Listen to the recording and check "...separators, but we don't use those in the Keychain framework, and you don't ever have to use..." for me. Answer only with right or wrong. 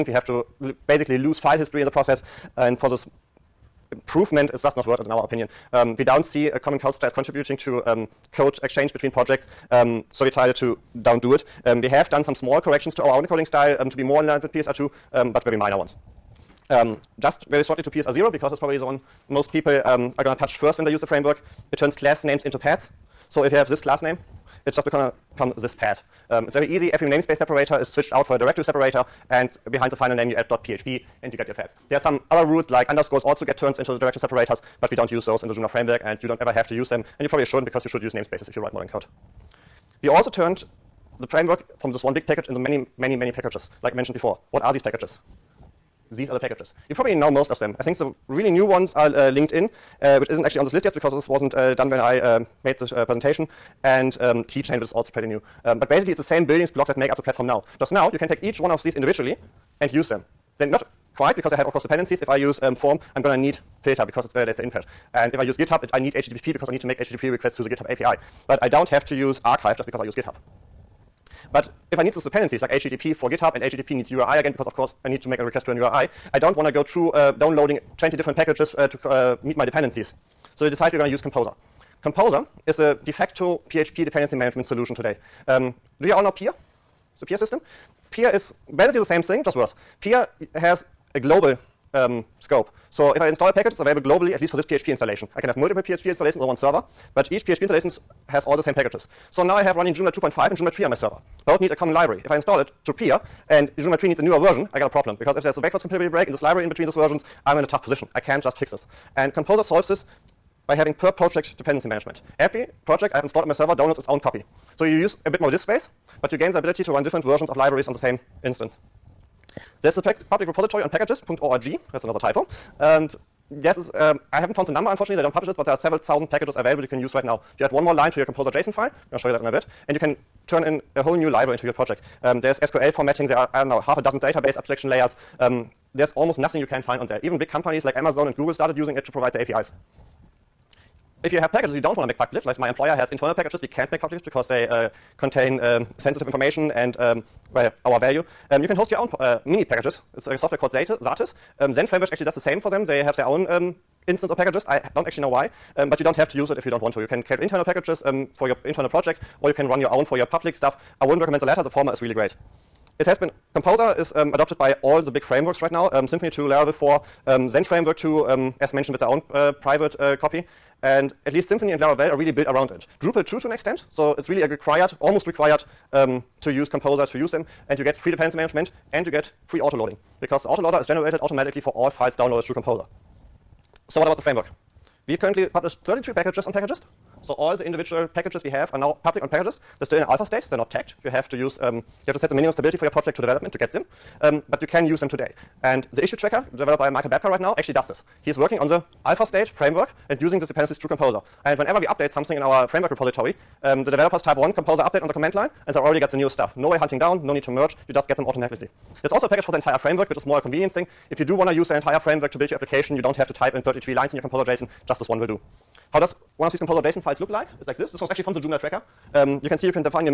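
wrong.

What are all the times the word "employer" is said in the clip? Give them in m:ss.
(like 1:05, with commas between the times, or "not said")
2:22.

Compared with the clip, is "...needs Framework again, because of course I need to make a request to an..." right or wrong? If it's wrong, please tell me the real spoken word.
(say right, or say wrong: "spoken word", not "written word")
wrong: "URI", not "Framework".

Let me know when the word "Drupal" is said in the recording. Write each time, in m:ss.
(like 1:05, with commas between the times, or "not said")
2:53.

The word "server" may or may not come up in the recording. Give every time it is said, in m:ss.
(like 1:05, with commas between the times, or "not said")
1:36, 1:40, 1:53.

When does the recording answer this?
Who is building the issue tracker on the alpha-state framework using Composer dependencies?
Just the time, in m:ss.
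3:16.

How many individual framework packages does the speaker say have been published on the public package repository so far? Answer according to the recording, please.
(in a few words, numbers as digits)
33.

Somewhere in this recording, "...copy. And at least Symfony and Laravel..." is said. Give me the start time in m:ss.
2:50.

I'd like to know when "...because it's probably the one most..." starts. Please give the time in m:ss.
0:18.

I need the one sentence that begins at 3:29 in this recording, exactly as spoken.
There's also a package for the entire framework, which is more a convenience thing.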